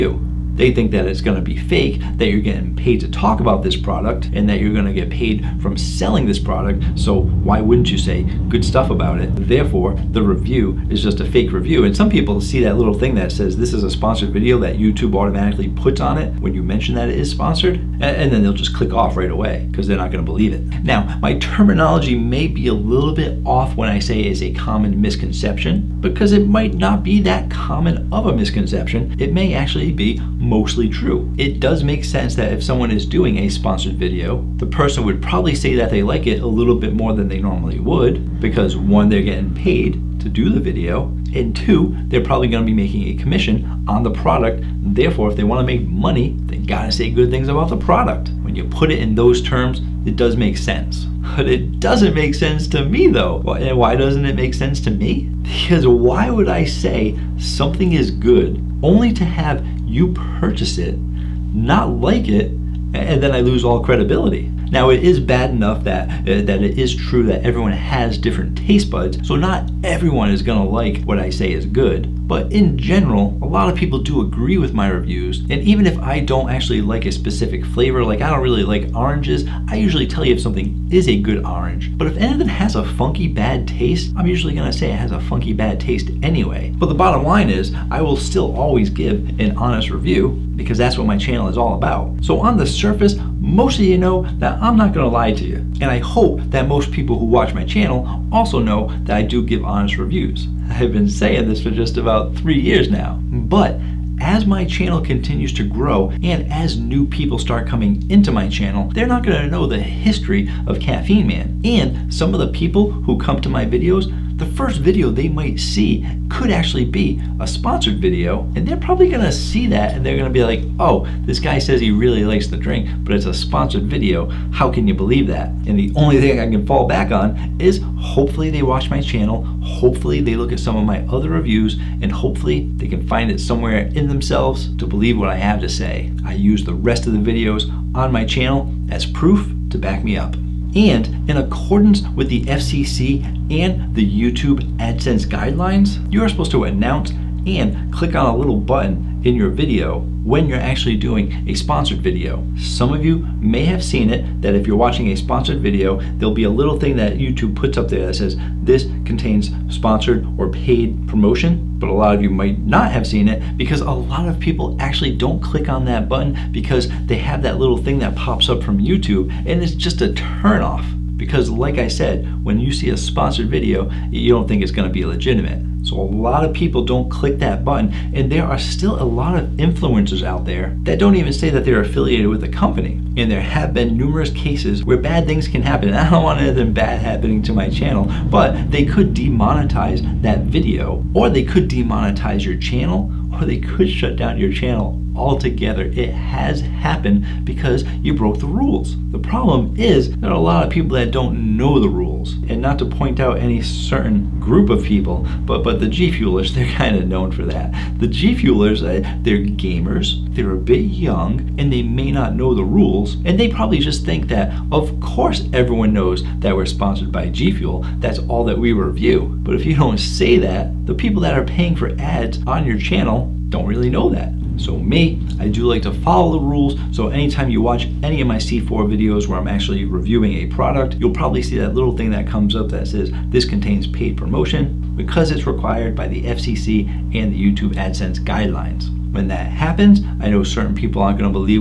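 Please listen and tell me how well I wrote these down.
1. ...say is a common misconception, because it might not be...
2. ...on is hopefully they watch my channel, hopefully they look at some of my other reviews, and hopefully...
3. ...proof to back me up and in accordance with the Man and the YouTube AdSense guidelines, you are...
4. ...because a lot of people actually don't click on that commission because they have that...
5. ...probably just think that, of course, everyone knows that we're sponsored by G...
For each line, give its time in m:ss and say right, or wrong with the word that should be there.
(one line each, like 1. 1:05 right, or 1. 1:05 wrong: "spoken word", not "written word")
1. 0:23 right
2. 2:07 right
3. 2:19 wrong: "FCC", not "Man"
4. 2:43 wrong: "button", not "commission"
5. 3:33 right.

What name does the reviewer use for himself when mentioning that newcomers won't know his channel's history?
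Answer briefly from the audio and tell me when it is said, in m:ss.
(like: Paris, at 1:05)
Caffeine Man, at 1:50.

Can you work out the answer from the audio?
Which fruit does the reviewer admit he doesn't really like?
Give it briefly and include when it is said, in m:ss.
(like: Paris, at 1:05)
Oranges, at 1:18.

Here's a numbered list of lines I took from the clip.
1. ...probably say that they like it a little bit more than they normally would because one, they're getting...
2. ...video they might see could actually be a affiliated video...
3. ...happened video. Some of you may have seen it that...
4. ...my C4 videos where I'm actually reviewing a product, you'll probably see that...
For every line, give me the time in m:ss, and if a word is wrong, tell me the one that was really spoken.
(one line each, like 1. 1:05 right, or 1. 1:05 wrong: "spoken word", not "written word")
1. 0:35 right
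2. 1:54 wrong: "sponsored", not "affiliated"
3. 2:31 wrong: "sponsored", not "happened"
4. 3:48 right.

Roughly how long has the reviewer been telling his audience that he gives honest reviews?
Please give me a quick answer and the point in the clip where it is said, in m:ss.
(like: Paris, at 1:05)
3 years, at 1:42.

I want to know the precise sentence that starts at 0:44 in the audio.
Therefore, if they wanna make money, they gotta say good things about the product.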